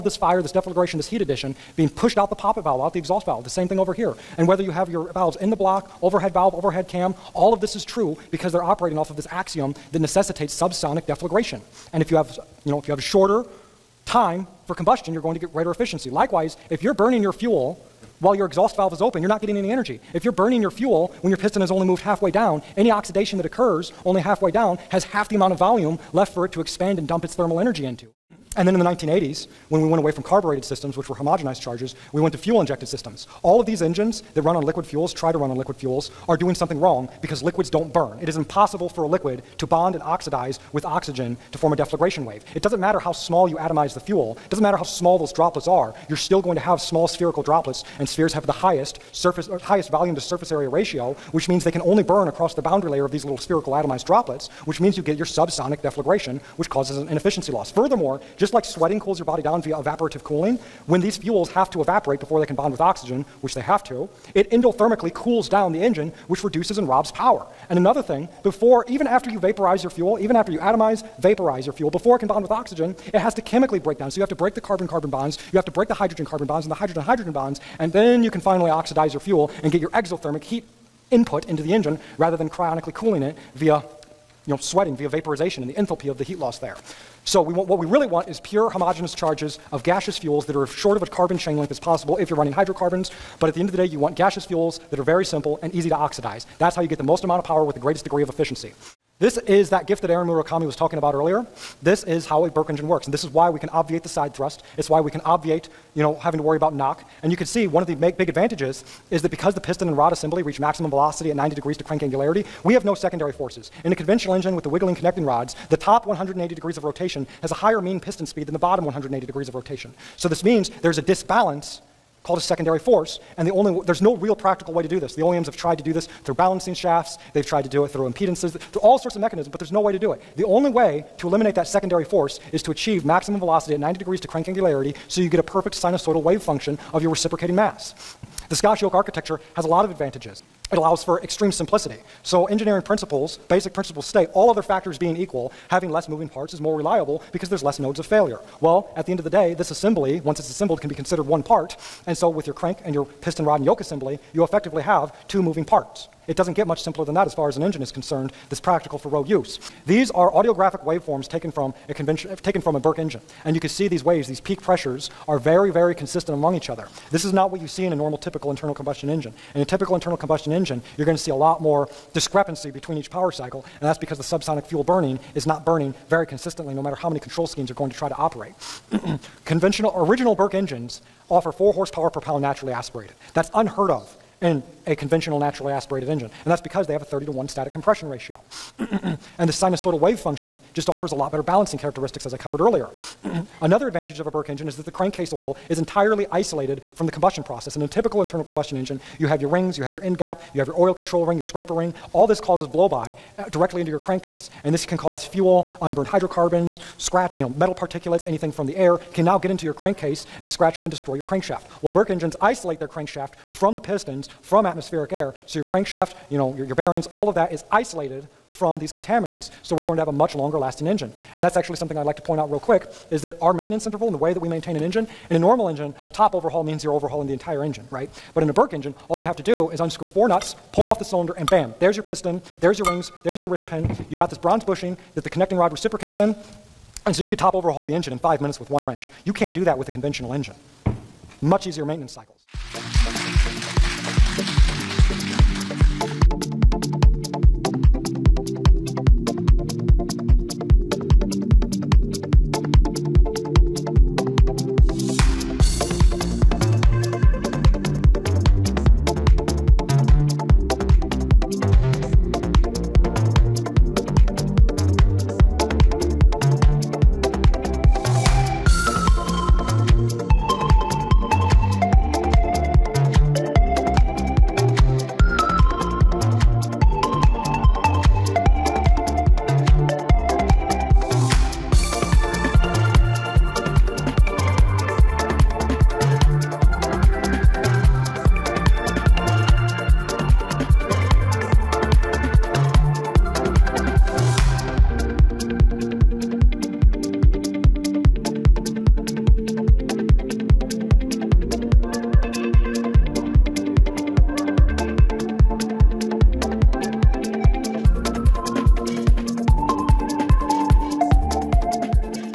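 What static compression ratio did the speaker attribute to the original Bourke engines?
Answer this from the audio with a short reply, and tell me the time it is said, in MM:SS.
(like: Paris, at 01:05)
30 to 1, at 03:07.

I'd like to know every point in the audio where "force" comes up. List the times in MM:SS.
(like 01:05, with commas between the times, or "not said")
01:53, 02:02, 02:12.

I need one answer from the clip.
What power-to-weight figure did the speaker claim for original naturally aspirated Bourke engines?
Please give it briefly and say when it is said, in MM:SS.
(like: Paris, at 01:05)
4 horsepower per pound, at 03:01.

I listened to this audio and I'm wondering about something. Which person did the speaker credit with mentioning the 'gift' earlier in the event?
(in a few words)
Aaron Murakami.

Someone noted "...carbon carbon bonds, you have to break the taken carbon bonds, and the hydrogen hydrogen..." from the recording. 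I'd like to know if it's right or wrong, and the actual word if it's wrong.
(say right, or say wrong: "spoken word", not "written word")
wrong: "hydrogen", not "taken".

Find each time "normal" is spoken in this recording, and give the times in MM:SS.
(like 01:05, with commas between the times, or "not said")
02:47, 03:45.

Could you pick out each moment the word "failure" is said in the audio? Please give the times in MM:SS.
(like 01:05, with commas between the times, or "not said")
02:28.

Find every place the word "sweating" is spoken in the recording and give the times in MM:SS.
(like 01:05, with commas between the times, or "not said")
00:58, 01:24.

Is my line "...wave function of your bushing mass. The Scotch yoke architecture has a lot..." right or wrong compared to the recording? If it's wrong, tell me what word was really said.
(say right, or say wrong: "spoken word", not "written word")
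wrong: "reciprocating", not "bushing".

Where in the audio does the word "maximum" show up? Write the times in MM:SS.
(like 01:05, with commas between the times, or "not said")
01:50, 02:13.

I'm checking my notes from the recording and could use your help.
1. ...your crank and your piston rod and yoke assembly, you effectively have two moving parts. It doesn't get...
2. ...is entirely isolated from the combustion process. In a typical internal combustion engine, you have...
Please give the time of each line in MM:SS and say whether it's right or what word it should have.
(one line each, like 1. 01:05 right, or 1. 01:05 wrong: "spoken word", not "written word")
1. 02:32 right
2. 03:15 right.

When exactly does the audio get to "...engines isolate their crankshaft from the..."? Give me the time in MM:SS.
03:32.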